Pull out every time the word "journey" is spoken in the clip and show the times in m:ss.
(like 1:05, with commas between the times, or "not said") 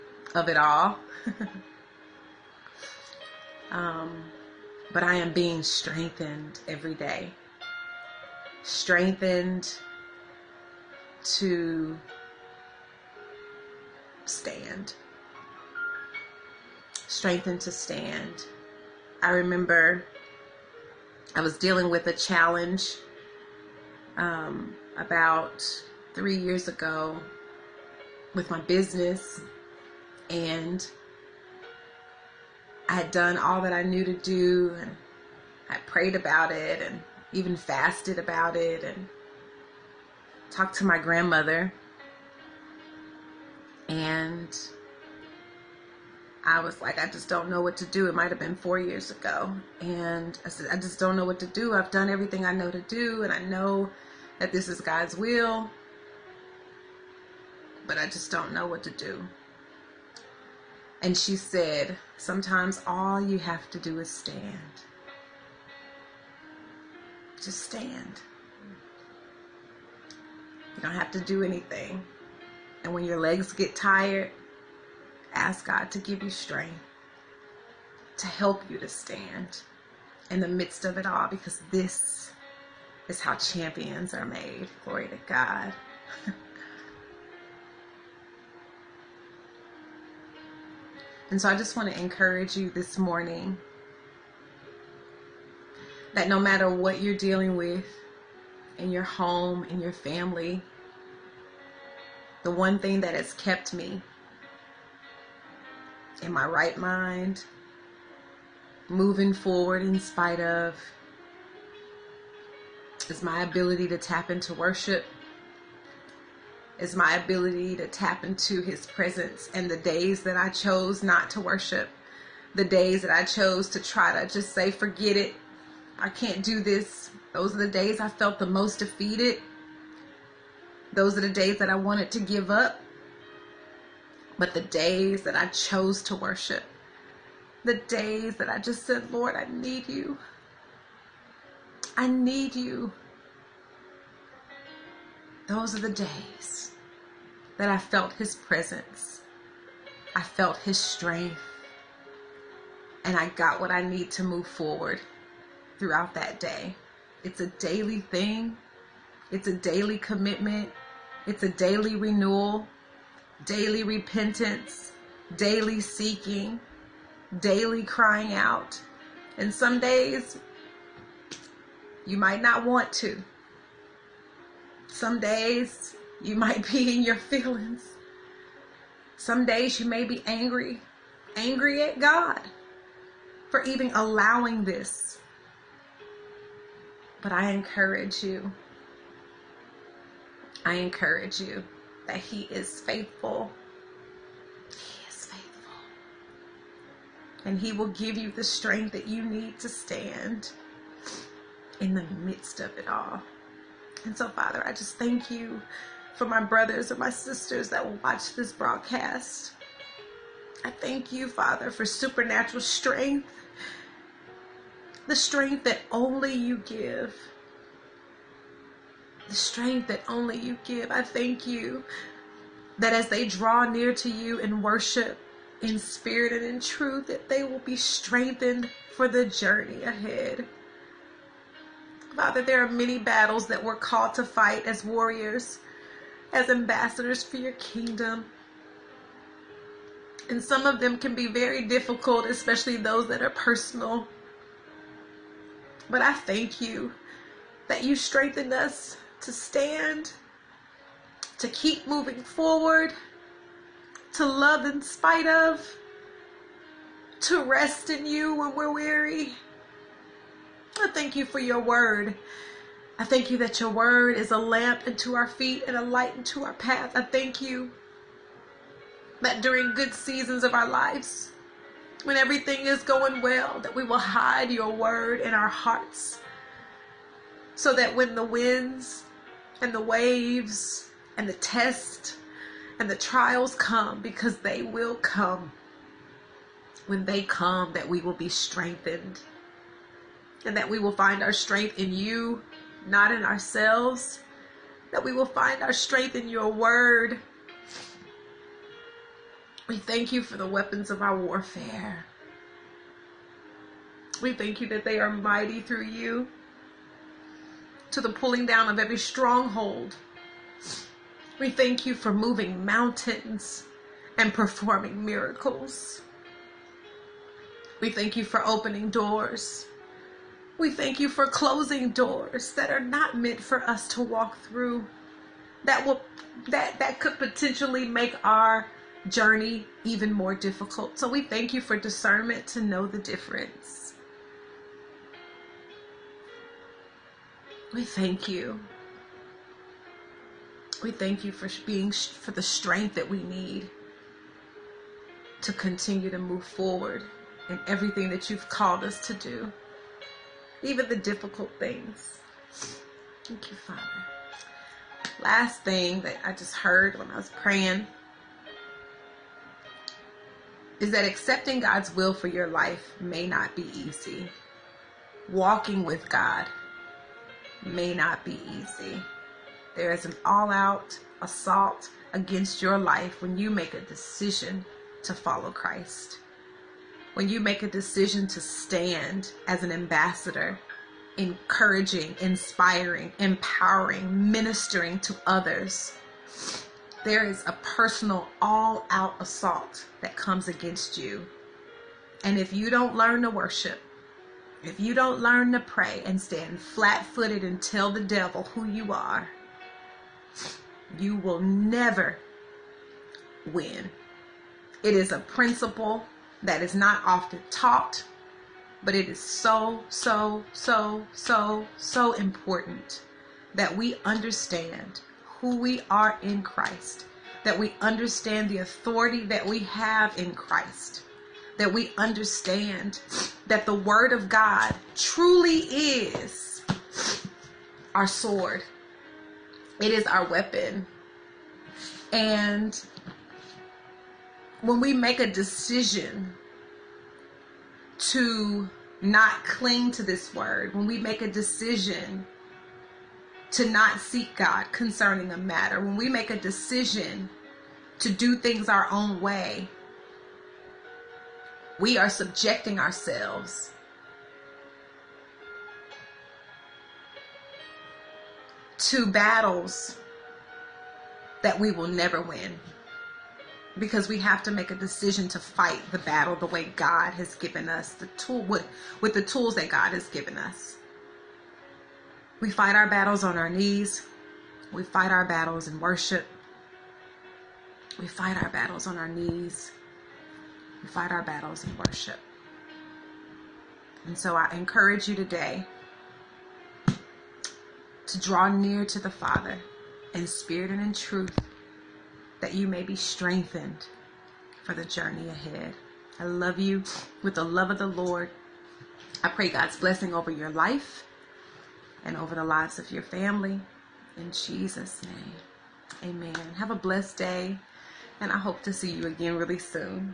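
3:49, 5:29, 8:14.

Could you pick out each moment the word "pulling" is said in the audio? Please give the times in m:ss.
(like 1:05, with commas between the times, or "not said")
5:08.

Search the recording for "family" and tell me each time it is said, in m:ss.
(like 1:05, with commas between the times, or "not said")
1:39, 8:23.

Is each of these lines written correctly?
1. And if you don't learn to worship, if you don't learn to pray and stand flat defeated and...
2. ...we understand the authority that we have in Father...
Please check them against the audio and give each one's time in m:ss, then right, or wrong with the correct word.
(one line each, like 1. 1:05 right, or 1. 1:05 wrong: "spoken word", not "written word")
1. 6:32 wrong: "footed", not "defeated"
2. 6:57 wrong: "Christ", not "Father".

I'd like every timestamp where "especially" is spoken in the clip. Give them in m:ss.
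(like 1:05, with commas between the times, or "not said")
4:02.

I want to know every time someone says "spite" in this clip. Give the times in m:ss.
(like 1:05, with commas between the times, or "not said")
1:50, 4:14.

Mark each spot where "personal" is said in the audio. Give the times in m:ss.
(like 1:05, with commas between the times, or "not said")
4:03, 6:27.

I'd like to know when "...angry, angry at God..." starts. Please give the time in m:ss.
3:00.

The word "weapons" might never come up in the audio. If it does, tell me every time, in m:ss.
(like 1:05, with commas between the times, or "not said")
5:00, 7:10.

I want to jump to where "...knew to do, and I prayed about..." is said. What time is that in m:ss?
0:33.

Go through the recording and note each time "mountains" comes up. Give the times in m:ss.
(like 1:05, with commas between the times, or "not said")
5:12.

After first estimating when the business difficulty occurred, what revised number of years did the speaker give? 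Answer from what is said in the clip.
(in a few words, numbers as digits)
4.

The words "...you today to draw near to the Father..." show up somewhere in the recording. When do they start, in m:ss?
8:05.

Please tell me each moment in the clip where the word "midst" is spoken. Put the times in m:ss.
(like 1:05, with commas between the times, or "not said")
1:20, 3:22.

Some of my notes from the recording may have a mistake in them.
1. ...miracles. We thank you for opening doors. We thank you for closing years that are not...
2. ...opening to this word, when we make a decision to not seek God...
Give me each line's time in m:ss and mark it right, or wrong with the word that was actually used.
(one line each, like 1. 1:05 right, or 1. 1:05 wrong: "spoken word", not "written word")
1. 5:15 wrong: "doors", not "years"
2. 7:19 wrong: "cling", not "opening".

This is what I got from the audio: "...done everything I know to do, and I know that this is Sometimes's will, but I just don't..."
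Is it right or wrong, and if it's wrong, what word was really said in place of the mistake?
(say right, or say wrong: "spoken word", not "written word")
wrong: "God", not "Sometimes".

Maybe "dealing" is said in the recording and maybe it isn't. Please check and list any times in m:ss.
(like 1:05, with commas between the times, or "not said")
0:21, 1:37.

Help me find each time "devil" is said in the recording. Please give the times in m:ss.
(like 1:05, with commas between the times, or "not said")
6:38.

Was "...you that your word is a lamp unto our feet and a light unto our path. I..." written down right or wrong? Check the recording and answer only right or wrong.
right.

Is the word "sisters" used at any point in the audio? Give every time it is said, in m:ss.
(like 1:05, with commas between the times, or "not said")
3:27.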